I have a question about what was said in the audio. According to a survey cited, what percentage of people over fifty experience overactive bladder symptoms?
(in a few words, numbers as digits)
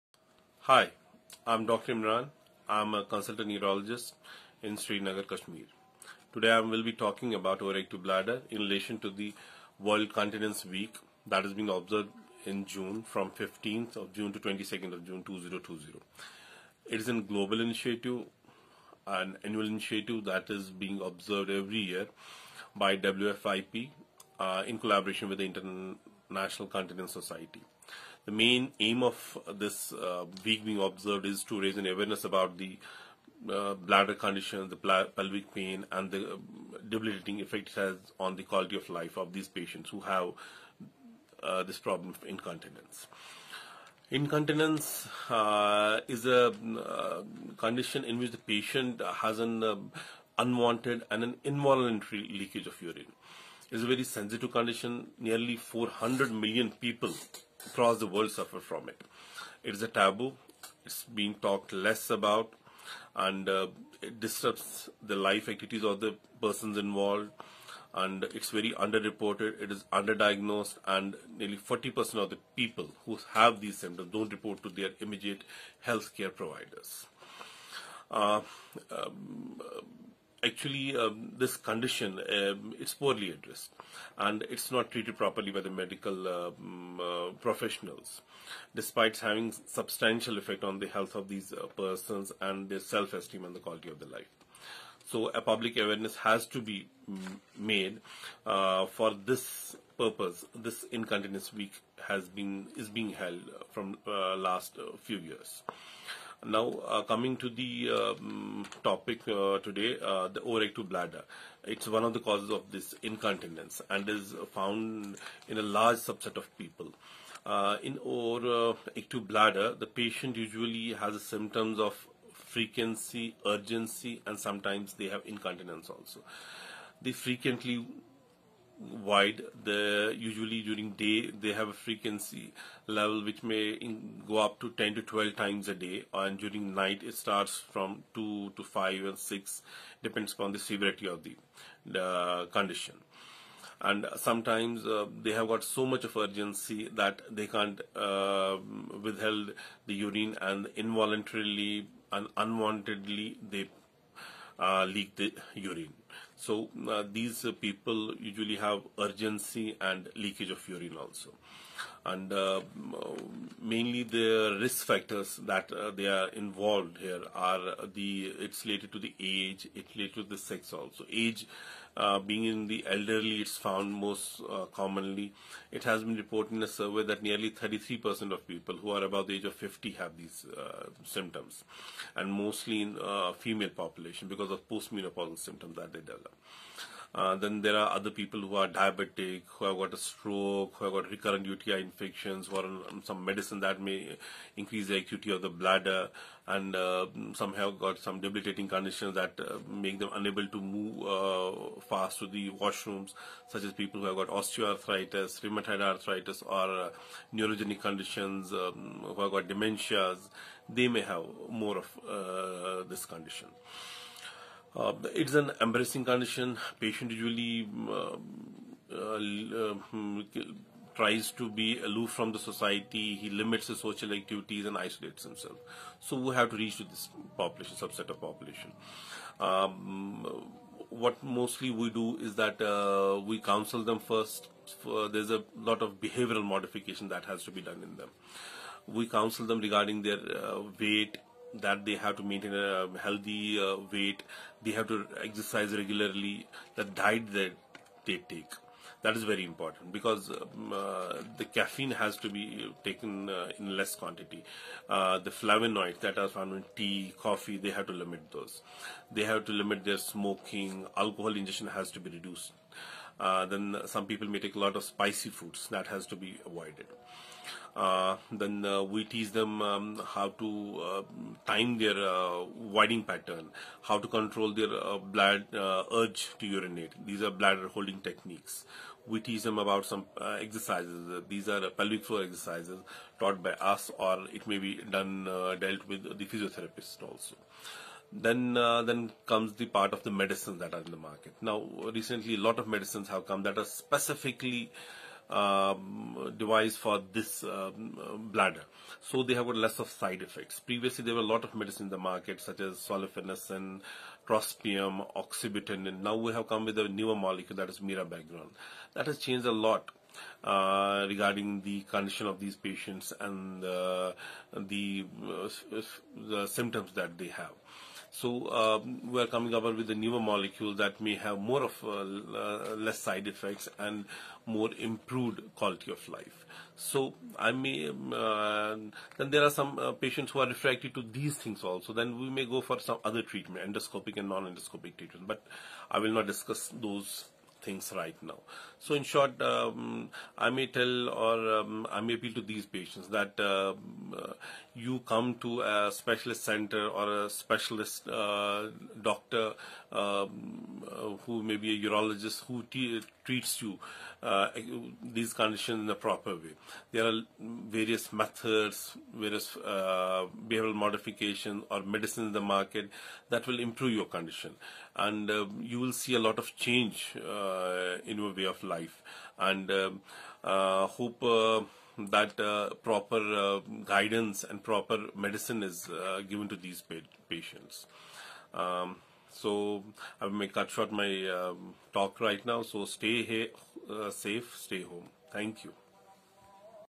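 33%.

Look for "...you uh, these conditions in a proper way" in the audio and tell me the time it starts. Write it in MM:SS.
05:53.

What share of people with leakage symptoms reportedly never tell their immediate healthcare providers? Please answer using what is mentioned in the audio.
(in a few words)
40%.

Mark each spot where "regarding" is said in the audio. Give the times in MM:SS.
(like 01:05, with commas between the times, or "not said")
03:59, 05:11.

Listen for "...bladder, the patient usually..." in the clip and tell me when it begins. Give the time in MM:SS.
01:59.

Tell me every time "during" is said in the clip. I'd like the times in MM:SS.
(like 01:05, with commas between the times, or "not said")
02:10, 02:16.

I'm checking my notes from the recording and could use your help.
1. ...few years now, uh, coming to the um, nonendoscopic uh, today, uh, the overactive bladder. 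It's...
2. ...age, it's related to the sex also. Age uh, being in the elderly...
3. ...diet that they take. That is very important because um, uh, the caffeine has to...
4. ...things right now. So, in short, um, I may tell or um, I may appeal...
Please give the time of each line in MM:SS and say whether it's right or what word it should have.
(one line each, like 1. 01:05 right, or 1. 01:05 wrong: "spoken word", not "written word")
1. 01:45 wrong: "topic", not "nonendoscopic"
2. 02:49 right
3. 04:06 right
4. 05:37 right.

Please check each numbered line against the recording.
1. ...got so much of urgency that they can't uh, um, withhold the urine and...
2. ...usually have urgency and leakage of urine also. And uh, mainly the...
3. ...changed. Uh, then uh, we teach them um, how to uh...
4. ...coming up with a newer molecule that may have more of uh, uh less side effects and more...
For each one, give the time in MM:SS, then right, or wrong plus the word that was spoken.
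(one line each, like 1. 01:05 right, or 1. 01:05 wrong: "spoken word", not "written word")
1. 02:25 right
2. 02:38 right
3. 04:26 wrong: "avoided", not "changed"
4. 05:19 right.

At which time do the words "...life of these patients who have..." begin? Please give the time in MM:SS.
00:38.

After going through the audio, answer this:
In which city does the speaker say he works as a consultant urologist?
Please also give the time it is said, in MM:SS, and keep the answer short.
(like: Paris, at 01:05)
Srinagar, at 00:04.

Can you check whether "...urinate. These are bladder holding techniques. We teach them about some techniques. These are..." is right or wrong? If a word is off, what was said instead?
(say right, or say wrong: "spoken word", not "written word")
wrong: "exercises", not "techniques".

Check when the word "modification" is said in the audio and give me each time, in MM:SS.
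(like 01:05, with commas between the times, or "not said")
03:56, 06:00.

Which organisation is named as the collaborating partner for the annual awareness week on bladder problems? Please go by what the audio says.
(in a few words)
International Continence Society.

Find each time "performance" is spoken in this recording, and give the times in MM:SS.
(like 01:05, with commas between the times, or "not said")
not said.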